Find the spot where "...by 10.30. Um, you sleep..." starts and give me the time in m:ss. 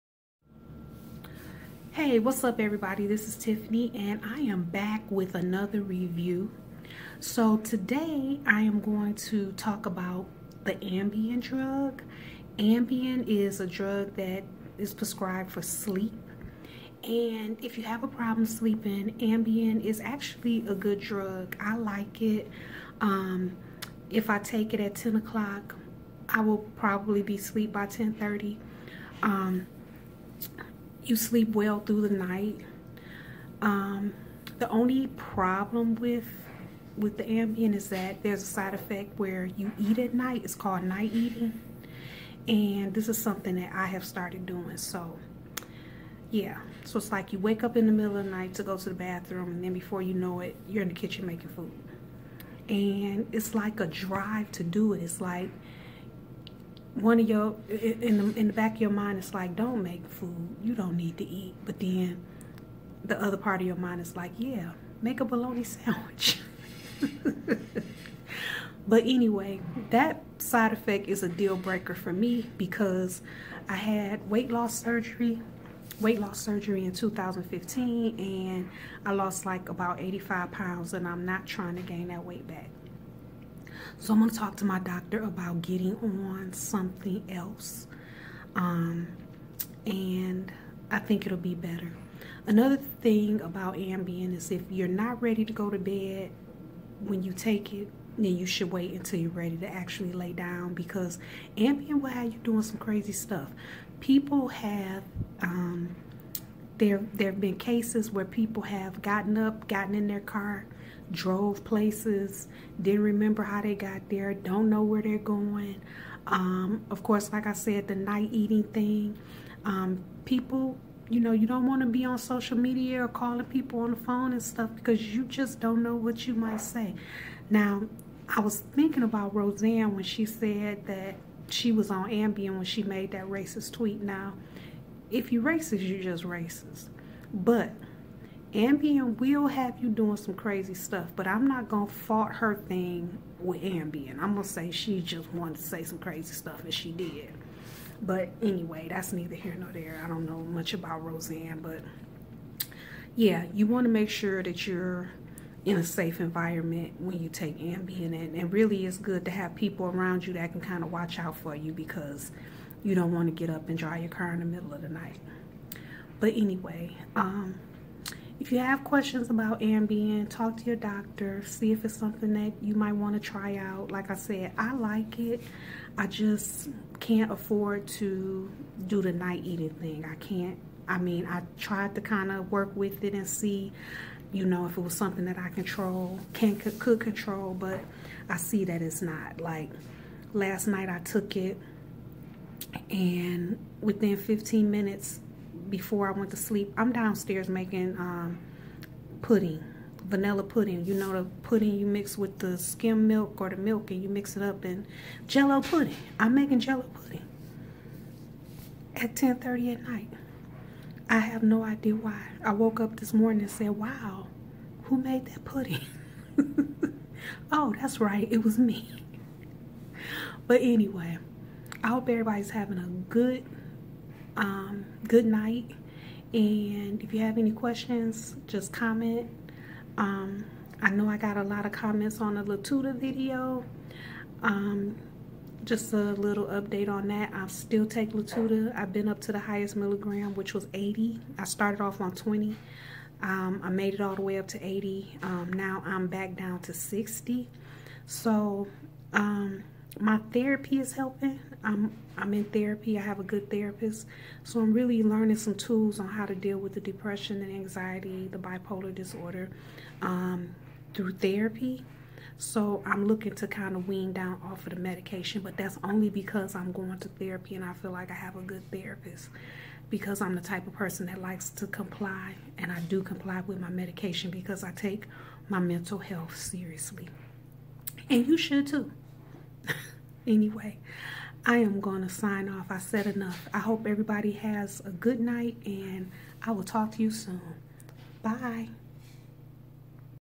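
0:27.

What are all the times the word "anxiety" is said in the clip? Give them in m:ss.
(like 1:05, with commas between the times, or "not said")
4:17.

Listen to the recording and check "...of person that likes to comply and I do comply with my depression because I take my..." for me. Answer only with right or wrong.
wrong.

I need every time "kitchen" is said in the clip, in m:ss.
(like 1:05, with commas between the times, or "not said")
0:50.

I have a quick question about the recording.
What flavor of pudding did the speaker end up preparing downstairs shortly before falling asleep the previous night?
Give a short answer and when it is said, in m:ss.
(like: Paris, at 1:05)
vanilla, at 3:20.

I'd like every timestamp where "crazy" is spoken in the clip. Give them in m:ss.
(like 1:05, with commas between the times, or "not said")
1:42, 2:20, 2:25.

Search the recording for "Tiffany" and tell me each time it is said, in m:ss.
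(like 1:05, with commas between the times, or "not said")
0:03.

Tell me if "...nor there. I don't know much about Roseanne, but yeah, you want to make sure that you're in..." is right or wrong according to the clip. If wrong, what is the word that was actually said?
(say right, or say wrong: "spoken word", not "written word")
right.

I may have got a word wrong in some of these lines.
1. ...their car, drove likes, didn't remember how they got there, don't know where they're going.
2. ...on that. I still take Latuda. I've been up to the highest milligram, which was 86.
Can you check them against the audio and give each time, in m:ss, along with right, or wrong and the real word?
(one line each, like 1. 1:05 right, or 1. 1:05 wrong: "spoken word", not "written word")
1. 1:50 wrong: "places", not "likes"
2. 3:56 wrong: "80", not "86".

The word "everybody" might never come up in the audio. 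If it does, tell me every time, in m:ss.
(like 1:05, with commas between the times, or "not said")
0:02, 3:42, 4:43.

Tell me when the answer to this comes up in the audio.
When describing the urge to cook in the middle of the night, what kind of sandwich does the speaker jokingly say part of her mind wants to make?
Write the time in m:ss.
1:05.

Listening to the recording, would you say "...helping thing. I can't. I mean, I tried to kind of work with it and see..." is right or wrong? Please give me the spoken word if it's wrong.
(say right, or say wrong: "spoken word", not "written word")
wrong: "eating", not "helping".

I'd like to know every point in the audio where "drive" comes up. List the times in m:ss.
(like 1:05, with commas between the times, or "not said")
0:53, 2:43.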